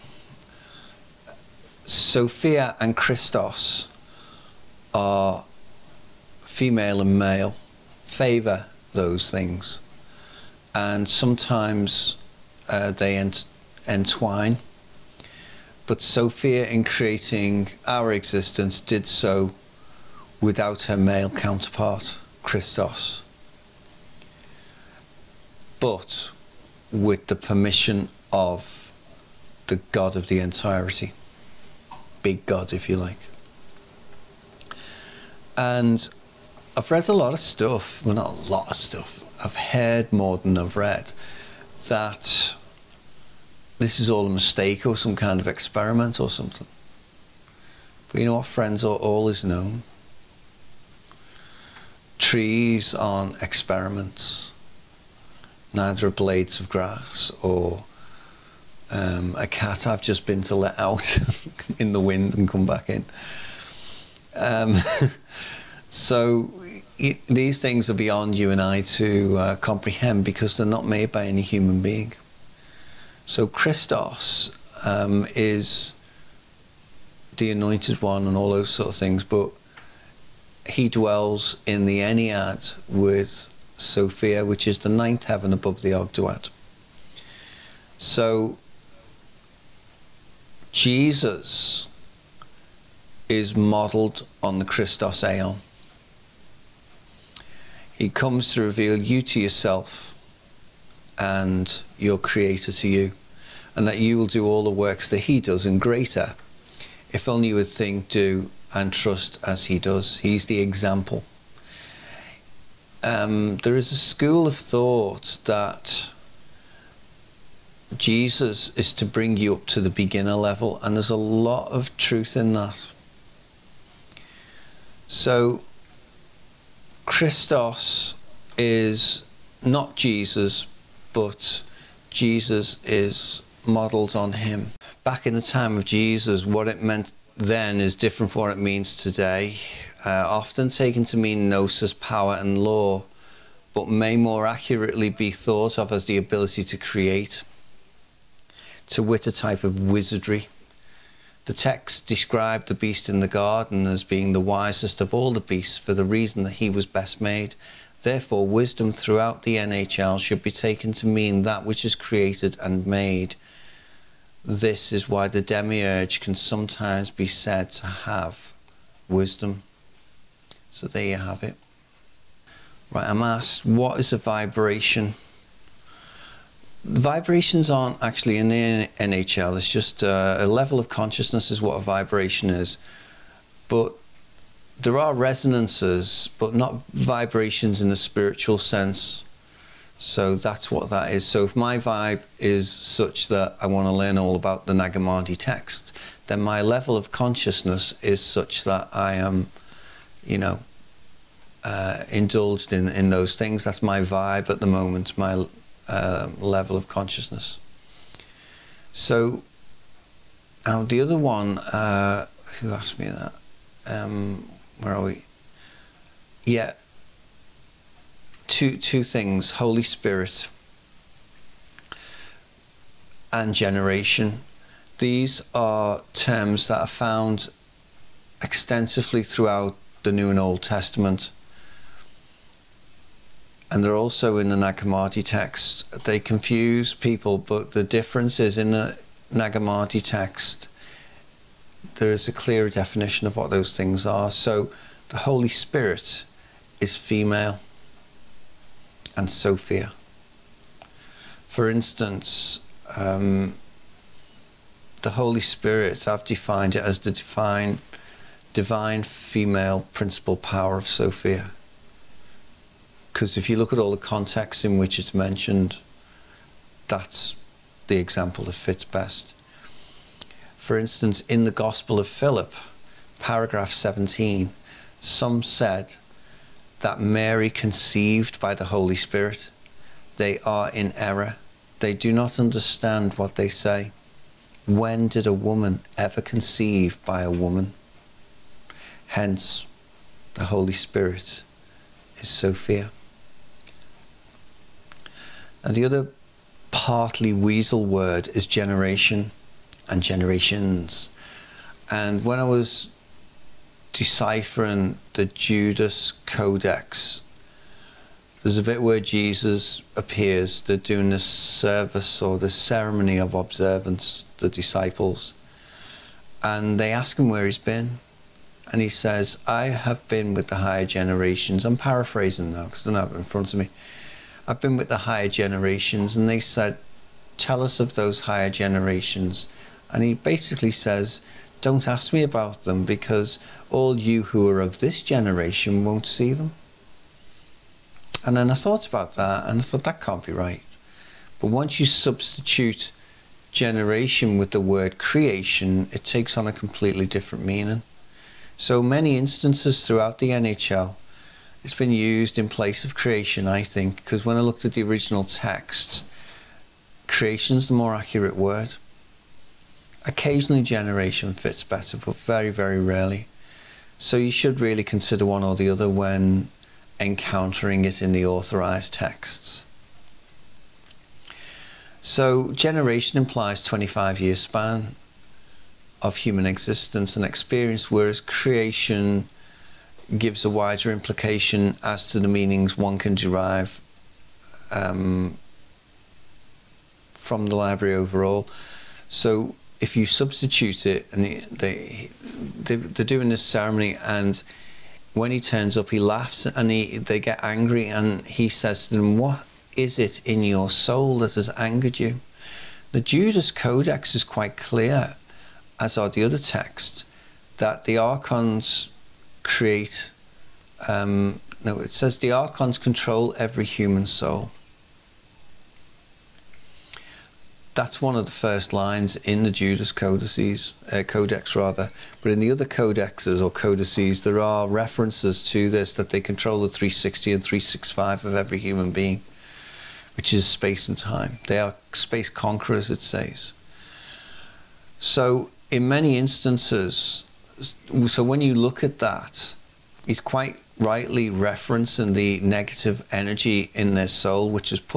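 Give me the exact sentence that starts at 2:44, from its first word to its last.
This is why the demiurge can sometimes be said to have wisdom.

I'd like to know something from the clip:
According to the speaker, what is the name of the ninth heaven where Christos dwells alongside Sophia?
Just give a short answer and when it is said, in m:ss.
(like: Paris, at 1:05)
Ennead, at 1:21.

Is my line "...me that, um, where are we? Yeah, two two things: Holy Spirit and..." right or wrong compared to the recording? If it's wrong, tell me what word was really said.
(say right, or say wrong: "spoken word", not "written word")
right.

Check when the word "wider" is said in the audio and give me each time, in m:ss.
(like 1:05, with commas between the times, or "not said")
6:20.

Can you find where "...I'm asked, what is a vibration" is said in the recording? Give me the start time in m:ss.
2:53.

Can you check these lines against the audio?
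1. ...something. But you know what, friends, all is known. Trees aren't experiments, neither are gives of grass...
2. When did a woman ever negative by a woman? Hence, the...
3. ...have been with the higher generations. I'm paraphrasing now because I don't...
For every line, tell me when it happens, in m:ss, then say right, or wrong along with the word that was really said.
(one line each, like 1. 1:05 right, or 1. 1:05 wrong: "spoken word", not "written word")
1. 0:46 wrong: "blades", not "gives"
2. 4:44 wrong: "conceive", not "negative"
3. 5:19 right.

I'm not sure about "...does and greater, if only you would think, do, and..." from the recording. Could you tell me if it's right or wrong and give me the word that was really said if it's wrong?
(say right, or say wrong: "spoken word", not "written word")
right.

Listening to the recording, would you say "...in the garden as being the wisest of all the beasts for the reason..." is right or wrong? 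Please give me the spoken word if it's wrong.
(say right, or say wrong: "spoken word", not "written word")
right.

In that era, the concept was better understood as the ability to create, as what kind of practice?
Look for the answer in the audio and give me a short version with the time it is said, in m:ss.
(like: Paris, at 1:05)
wizardry, at 2:29.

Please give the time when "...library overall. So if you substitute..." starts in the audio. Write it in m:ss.
6:27.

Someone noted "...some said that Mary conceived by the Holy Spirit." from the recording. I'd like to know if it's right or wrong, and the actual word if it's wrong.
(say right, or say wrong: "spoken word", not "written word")
right.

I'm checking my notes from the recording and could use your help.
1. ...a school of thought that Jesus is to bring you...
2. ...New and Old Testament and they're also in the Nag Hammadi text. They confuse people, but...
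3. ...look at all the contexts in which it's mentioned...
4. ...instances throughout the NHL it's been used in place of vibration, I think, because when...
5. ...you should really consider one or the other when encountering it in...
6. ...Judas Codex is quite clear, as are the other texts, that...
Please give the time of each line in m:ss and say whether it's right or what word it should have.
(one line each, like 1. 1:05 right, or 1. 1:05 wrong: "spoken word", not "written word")
1. 1:53 right
2. 3:50 right
3. 4:23 right
4. 5:49 wrong: "creation", not "vibration"
5. 6:04 right
6. 6:43 right.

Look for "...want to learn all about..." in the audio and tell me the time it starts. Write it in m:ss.
3:13.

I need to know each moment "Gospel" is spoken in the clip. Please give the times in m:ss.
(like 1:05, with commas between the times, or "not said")
4:31.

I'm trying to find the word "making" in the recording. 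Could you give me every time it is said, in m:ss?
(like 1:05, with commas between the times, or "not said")
not said.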